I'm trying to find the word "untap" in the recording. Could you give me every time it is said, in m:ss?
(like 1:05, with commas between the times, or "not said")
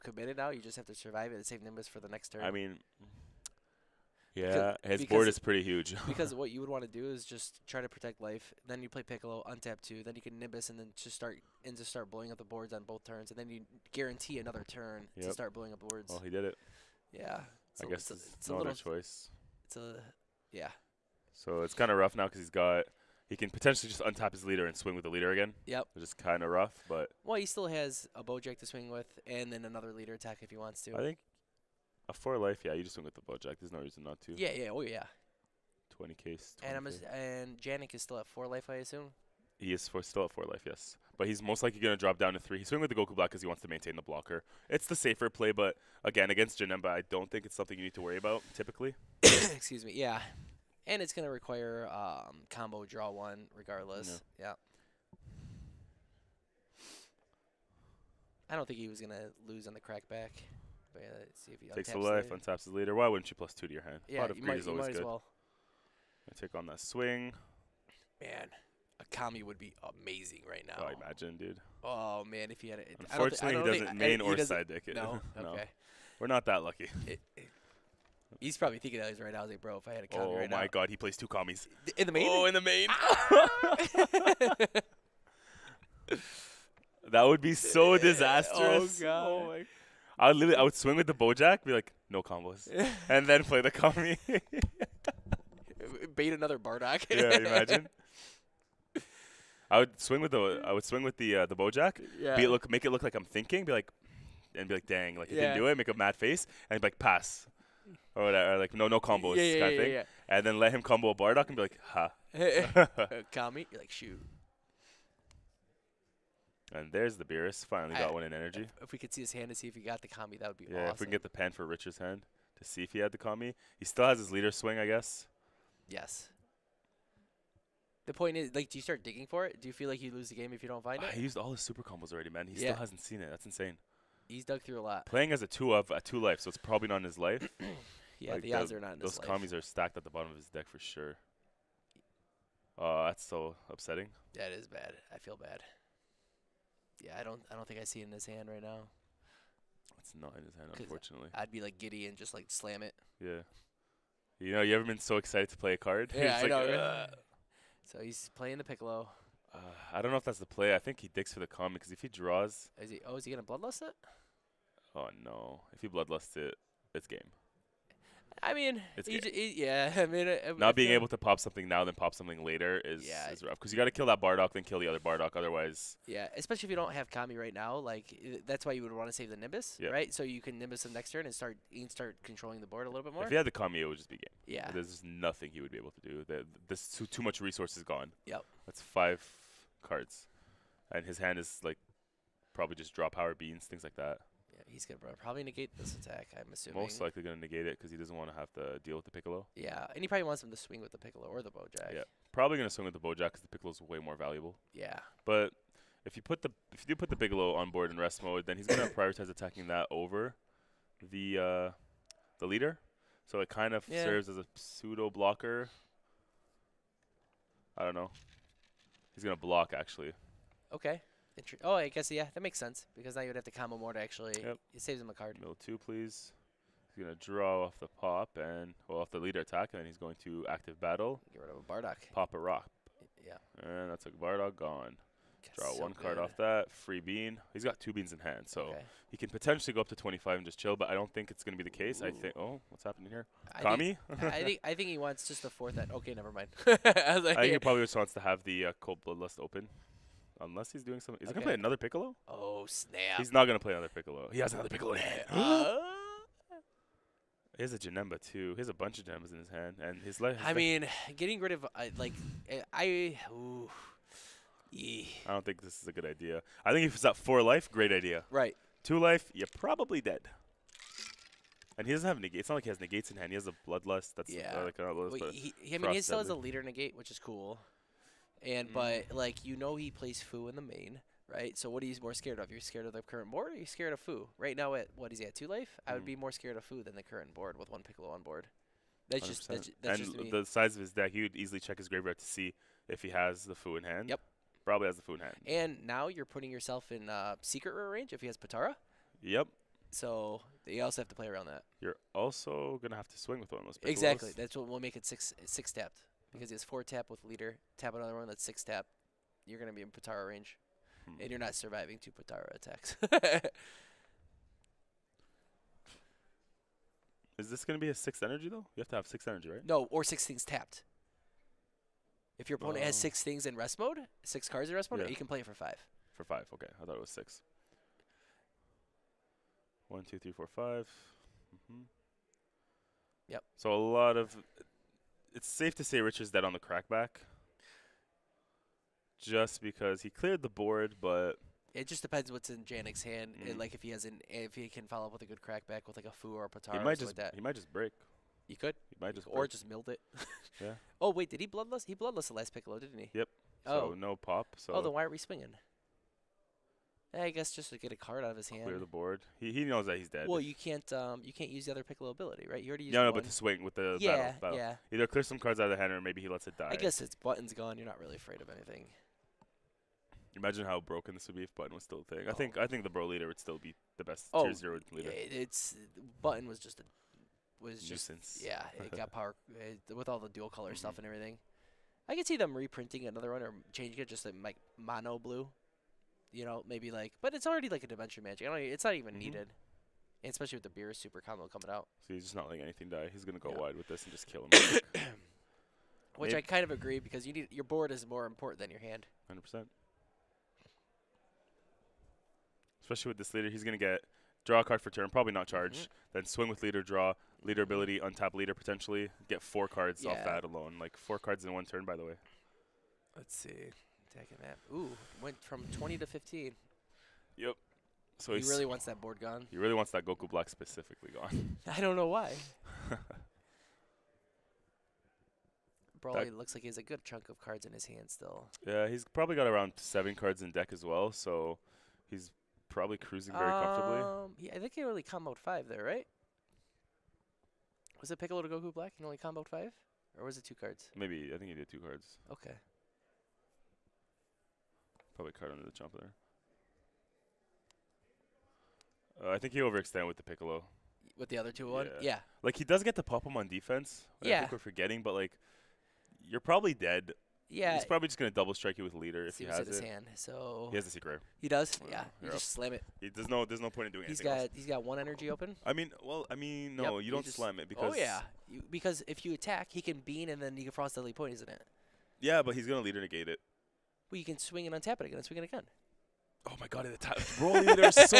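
0:09, 0:24, 1:02, 6:47, 7:54.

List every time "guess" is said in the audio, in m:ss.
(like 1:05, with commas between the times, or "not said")
0:17, 2:04, 3:41, 5:57, 6:06.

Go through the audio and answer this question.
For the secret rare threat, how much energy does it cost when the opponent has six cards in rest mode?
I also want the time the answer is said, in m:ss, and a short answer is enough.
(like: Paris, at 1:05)
5, at 5:25.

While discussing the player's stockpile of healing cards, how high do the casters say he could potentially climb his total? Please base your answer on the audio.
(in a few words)
25.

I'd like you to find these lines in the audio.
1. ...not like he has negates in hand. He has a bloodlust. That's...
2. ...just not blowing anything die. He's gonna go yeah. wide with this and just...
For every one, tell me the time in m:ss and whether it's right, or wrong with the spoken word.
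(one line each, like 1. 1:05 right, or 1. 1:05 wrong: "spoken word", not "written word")
1. 4:32 right
2. 6:32 wrong: "letting", not "blowing".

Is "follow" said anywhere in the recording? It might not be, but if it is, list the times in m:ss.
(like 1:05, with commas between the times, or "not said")
5:44.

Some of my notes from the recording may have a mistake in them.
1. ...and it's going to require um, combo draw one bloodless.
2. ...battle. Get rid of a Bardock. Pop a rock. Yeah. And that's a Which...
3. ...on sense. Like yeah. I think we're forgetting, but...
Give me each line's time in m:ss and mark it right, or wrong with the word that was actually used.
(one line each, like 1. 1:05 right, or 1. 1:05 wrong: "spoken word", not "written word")
1. 0:50 wrong: "regardless", not "bloodless"
2. 3:50 wrong: "Bardock", not "Which"
3. 7:33 wrong: "defense", not "sense".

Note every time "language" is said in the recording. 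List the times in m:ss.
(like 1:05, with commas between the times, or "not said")
not said.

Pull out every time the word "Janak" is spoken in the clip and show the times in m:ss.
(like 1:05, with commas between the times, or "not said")
0:37, 5:42.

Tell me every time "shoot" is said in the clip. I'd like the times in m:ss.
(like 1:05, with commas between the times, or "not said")
1:53.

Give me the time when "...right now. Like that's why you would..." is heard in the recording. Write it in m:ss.
2:57.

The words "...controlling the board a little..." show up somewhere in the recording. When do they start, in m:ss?
3:02.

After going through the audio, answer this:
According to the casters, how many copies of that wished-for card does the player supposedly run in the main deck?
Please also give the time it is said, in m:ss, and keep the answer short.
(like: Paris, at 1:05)
2, at 1:20.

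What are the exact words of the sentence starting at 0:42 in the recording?
He's swinging with the Goku Black because he wants to maintain the blocker.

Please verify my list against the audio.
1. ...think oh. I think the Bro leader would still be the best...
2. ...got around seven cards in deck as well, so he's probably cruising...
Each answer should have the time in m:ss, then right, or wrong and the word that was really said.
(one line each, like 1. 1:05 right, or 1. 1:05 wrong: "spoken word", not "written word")
1. 6:12 right
2. 7:09 right.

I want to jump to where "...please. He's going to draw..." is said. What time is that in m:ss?
3:45.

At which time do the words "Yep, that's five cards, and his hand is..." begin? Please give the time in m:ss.
3:08.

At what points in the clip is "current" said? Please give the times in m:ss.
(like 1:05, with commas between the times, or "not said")
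4:43, 4:47.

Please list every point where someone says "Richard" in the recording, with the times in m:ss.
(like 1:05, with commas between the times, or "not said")
2:01, 5:35.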